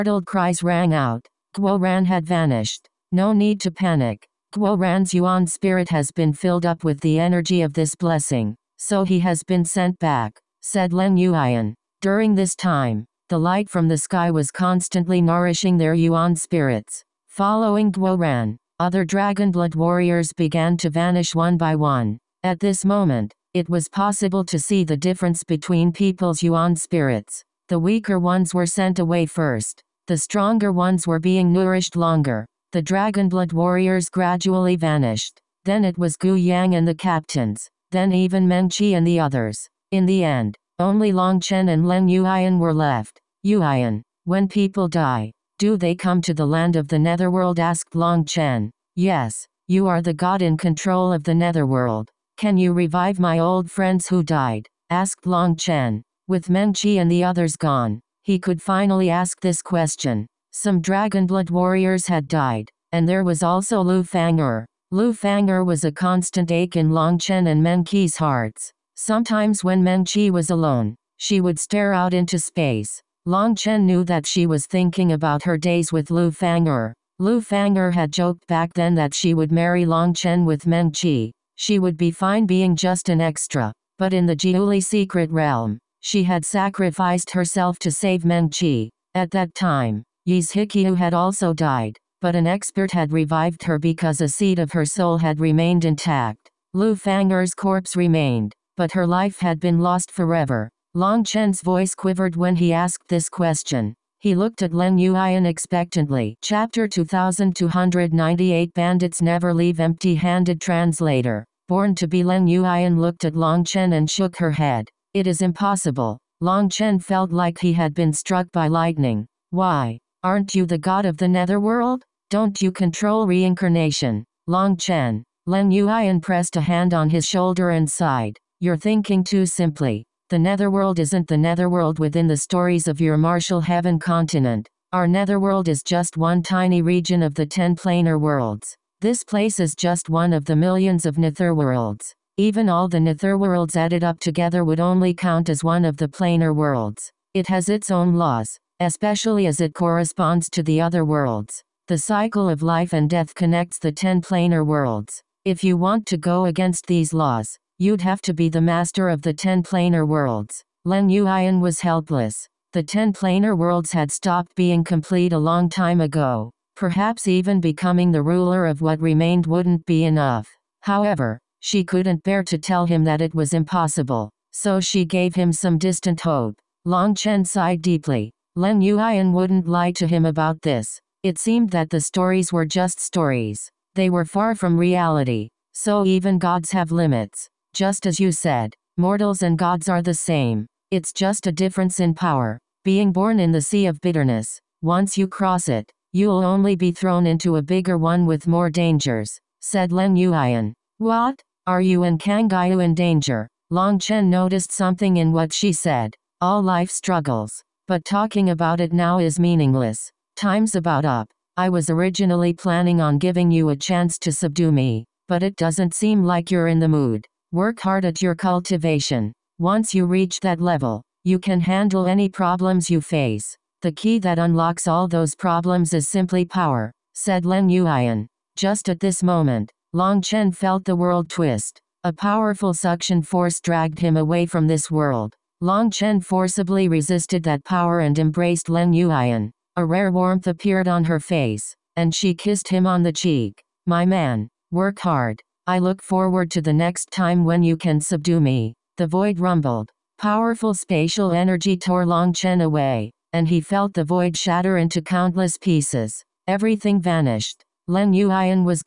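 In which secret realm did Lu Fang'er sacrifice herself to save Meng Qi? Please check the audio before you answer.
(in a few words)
Jiuli.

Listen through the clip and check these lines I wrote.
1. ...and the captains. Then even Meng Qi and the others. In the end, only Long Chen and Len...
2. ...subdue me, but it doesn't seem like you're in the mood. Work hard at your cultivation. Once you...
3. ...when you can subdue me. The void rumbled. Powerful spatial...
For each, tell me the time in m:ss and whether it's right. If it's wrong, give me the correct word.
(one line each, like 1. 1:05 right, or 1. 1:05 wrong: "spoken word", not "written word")
1. 0:36 right
2. 3:34 right
3. 4:07 right.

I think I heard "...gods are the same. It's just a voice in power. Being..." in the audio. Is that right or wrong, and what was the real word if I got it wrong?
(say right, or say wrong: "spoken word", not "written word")
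wrong: "difference", not "voice".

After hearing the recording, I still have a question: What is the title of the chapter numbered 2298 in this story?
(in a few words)
Bandits Never Leave Empty Handed.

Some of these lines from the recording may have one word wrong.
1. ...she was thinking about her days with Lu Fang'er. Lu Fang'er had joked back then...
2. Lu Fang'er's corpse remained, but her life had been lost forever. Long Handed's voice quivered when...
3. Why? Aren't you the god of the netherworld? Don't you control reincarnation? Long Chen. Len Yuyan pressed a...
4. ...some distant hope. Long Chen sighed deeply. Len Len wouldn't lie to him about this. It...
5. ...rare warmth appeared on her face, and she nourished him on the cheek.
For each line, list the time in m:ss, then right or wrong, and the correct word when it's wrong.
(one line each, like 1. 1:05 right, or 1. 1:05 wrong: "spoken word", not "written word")
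1. 1:14 right
2. 1:36 wrong: "Chen", not "Handed"
3. 1:59 right
4. 2:55 wrong: "Yuyan", not "Len"
5. 3:59 wrong: "kissed", not "nourished".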